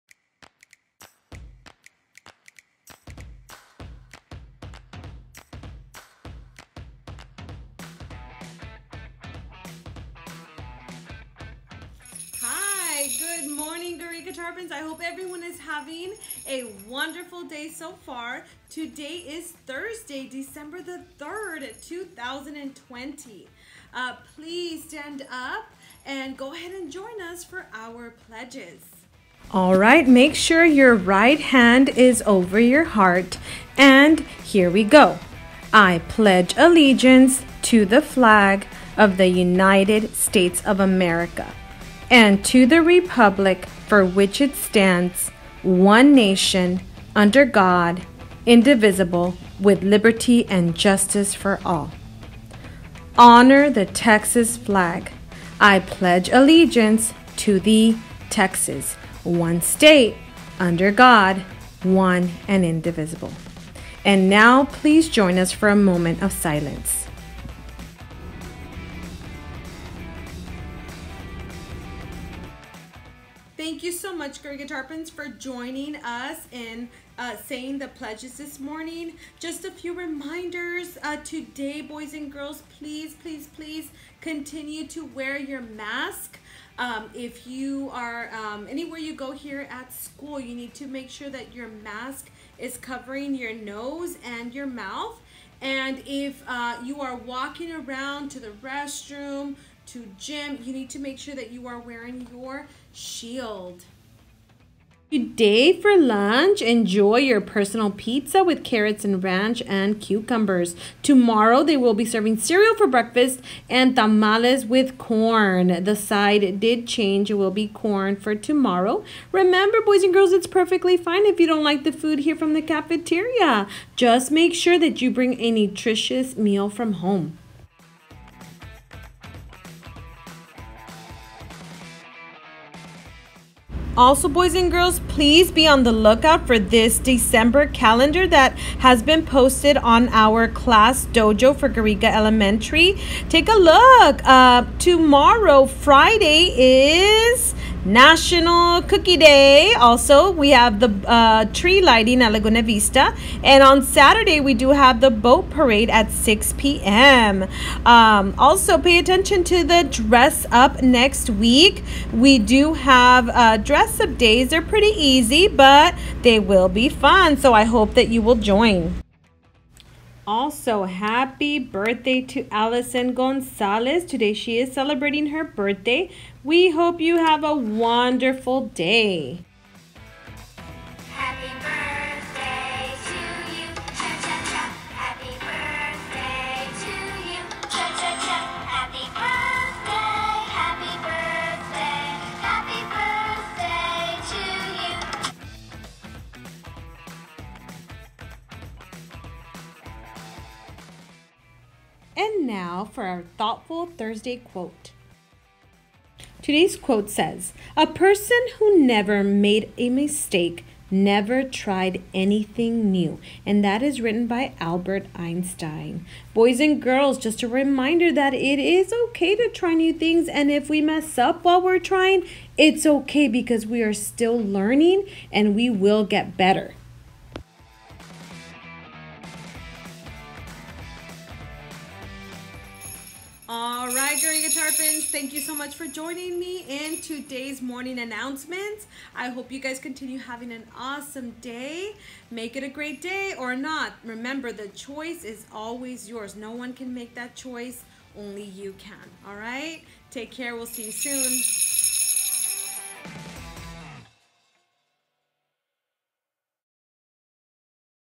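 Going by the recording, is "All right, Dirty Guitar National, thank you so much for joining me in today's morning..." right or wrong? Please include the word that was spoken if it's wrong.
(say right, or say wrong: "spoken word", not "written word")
wrong: "Fans", not "National".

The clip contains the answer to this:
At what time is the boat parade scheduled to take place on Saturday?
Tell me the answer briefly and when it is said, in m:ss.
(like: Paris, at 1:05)
6 p.m., at 2:36.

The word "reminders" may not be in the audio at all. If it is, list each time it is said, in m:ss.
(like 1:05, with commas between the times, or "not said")
1:19, 3:37.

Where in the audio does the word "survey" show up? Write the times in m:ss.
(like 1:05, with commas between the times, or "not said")
not said.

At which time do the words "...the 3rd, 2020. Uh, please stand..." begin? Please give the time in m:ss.
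0:20.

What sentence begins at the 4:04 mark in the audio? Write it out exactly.
Remember, the choice is always yours.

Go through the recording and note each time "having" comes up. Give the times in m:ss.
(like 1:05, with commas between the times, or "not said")
0:15, 4:00.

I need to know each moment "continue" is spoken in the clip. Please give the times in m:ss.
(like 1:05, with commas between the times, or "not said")
1:24, 3:59.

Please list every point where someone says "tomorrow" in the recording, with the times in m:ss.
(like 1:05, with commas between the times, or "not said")
1:51, 1:58, 2:24.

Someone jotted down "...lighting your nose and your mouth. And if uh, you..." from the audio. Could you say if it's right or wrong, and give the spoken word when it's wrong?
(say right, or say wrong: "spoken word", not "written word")
wrong: "covering", not "lighting".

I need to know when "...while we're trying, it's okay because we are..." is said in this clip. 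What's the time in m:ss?
3:41.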